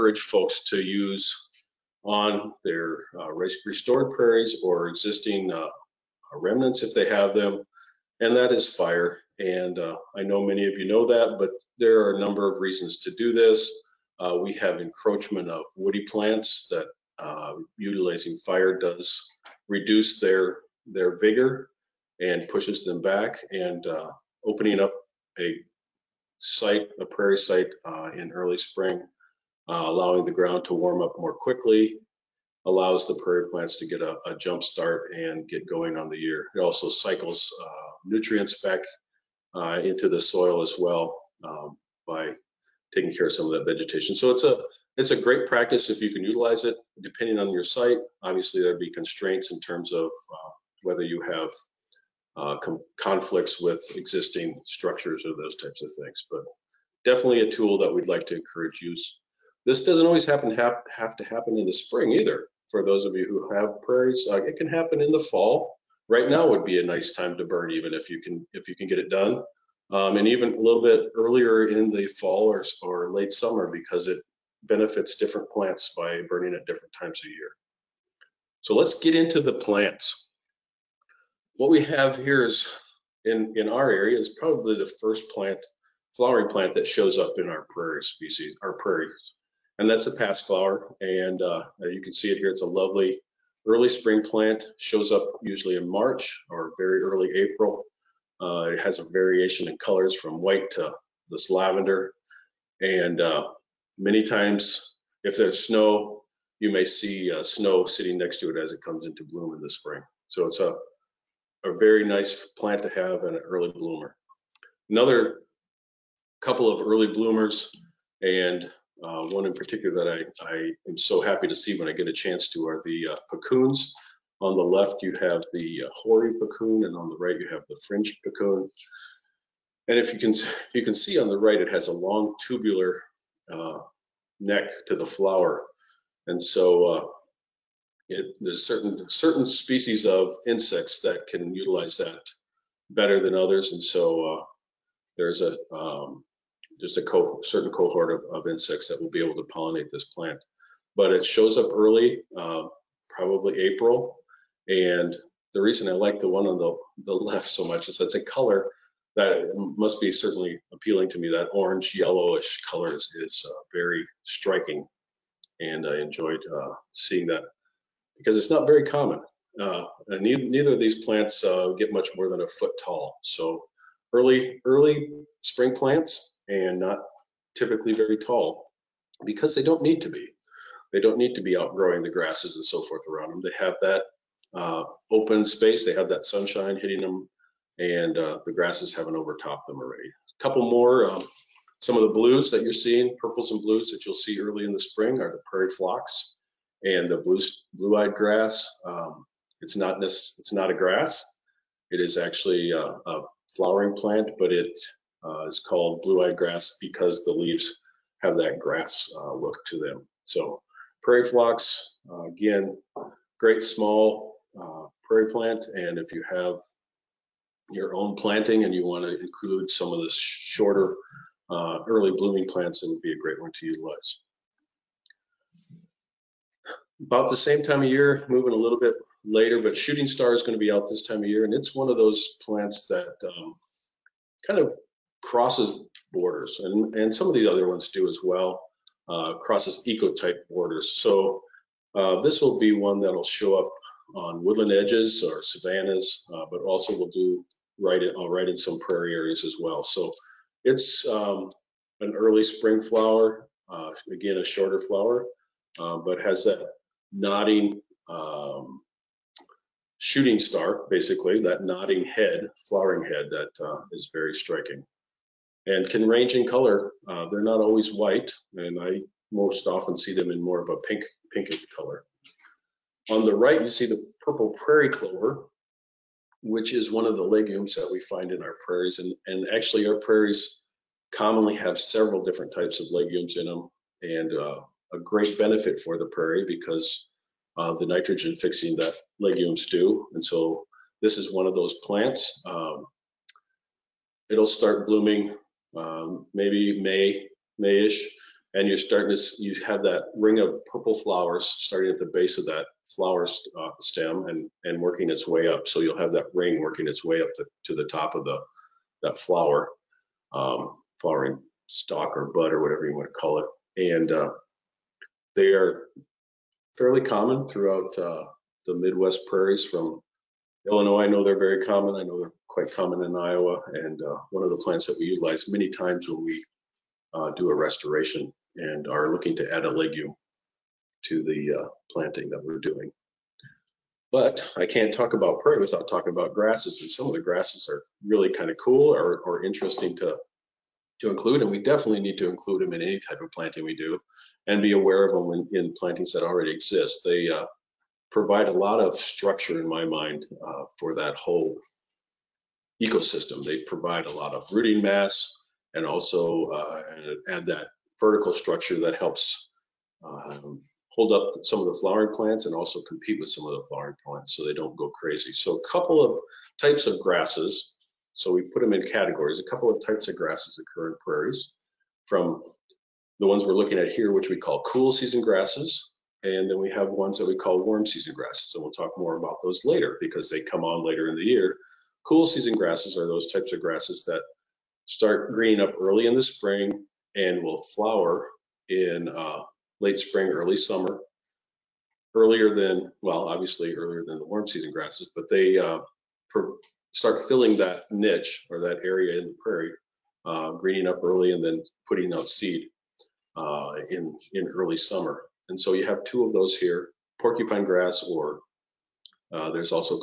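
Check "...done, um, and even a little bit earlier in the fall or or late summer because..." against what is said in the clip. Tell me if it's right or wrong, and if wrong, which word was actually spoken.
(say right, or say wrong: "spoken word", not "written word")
right.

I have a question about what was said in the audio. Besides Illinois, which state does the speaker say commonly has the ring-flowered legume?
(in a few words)
Iowa.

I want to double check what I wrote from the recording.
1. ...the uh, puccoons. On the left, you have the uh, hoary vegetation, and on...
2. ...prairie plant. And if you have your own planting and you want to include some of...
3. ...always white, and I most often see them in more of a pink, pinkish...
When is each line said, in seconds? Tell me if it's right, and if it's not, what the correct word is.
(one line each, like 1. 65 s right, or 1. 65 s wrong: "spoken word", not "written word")
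1. 122 s wrong: "puccoon", not "vegetation"
2. 215 s right
3. 267 s right.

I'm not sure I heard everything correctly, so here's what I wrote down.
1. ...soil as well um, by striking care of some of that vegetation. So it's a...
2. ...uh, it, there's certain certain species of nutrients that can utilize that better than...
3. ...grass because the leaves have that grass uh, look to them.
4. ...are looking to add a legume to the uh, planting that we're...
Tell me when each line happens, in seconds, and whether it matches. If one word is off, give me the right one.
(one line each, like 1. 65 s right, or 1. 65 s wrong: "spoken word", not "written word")
1. 40 s wrong: "taking", not "striking"
2. 136 s wrong: "insects", not "nutrients"
3. 206 s right
4. 328 s right.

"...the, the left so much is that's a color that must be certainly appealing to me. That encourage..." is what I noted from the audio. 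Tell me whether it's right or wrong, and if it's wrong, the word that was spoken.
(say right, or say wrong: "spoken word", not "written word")
wrong: "orange", not "encourage".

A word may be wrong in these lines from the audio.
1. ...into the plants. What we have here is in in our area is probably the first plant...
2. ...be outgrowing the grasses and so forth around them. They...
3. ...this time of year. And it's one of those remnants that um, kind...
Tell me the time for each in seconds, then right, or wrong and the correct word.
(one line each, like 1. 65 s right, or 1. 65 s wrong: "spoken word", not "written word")
1. 79 s right
2. 181 s right
3. 230 s wrong: "plants", not "remnants".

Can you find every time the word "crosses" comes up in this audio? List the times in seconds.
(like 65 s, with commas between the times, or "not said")
235 s, 239 s.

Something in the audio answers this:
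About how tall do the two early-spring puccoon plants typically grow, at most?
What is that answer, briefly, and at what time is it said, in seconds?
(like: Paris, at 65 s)
a foot, at 172 s.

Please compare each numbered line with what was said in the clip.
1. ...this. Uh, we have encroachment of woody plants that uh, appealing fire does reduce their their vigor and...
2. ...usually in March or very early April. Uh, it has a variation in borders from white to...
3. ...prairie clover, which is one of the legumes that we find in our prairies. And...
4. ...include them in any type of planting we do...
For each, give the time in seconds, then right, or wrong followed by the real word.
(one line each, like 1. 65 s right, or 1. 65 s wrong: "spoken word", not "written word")
1. 13 s wrong: "utilizing", not "appealing"
2. 95 s wrong: "colors", not "borders"
3. 274 s right
4. 342 s right.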